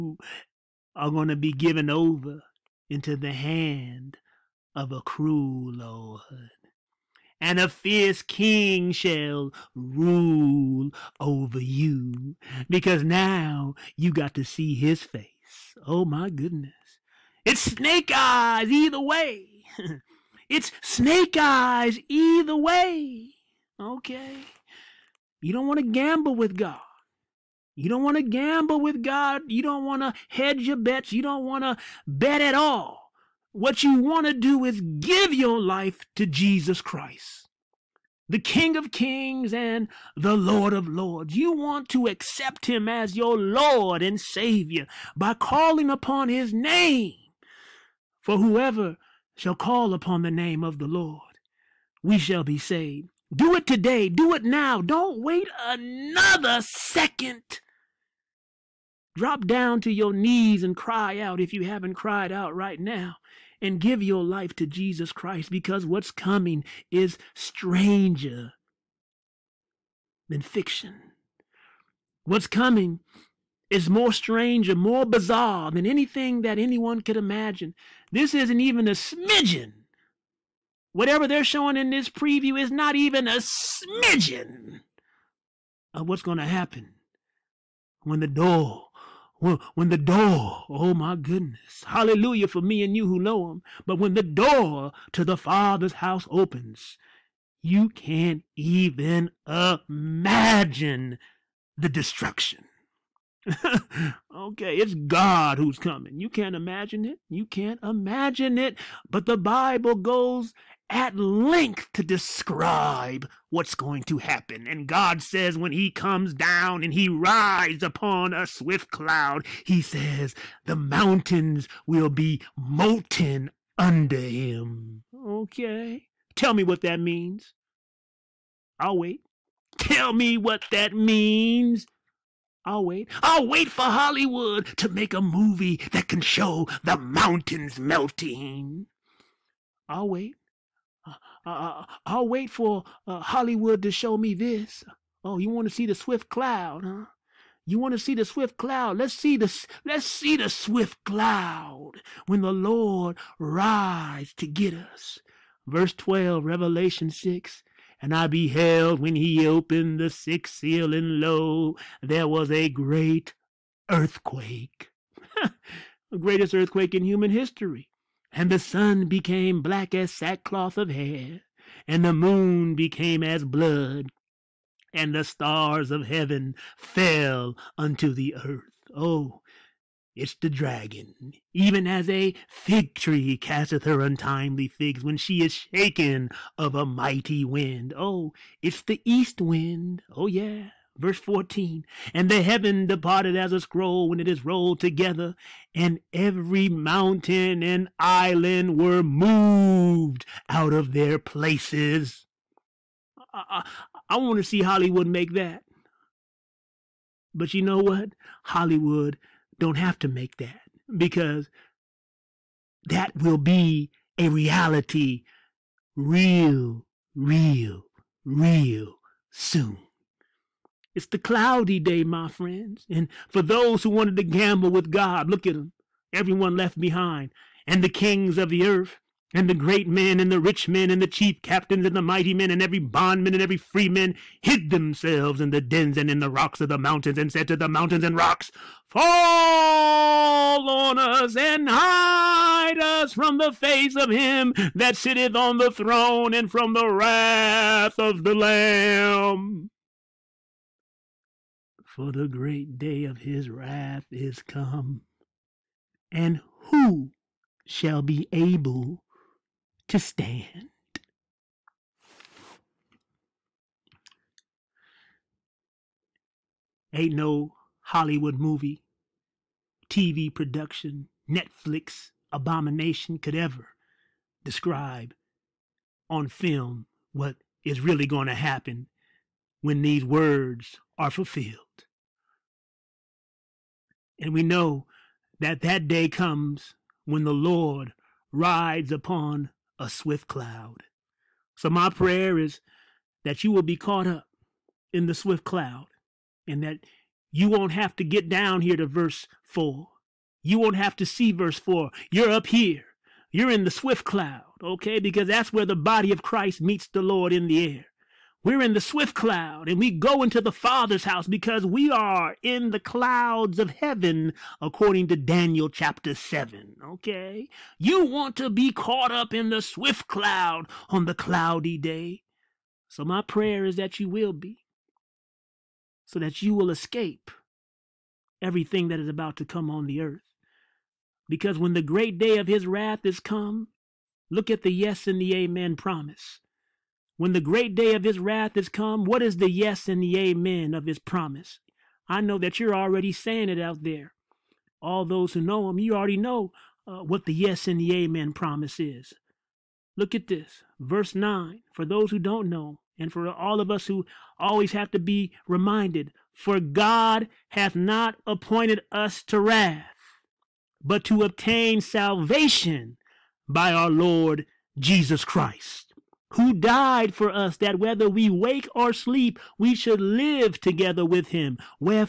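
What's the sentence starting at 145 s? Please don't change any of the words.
Oh, you want to see the swift cloud, huh?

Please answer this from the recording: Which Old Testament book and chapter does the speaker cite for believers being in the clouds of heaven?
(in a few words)
Daniel 7.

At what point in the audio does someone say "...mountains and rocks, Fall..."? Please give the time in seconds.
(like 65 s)
237 s.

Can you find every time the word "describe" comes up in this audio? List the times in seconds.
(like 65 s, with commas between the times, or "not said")
112 s, 274 s.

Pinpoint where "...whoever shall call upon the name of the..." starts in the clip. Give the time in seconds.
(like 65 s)
48 s.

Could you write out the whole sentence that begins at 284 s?
And we know that that day comes when the Lord rides upon a swift cloud.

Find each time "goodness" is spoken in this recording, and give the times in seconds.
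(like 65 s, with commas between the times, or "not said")
16 s, 91 s.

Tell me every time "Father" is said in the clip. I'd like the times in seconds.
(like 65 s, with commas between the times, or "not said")
95 s, 310 s.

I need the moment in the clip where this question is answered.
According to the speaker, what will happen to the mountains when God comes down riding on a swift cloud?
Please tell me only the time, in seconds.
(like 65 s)
122 s.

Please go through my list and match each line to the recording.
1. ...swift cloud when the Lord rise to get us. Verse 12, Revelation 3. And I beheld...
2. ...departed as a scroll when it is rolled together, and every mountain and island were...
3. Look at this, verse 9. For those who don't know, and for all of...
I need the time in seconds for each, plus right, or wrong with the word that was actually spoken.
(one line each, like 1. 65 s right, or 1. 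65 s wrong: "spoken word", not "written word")
1. 150 s wrong: "6", not "3"
2. 192 s right
3. 349 s right.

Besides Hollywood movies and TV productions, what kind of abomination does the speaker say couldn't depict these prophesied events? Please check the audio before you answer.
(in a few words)
Netflix.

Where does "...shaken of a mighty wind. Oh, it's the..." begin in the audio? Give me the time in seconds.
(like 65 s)
185 s.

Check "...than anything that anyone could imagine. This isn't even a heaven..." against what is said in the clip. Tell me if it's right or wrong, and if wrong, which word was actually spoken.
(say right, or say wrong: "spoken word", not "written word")
wrong: "smidgen", not "heaven".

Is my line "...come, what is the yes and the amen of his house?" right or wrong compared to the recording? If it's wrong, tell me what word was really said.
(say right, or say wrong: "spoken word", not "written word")
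wrong: "promise", not "house".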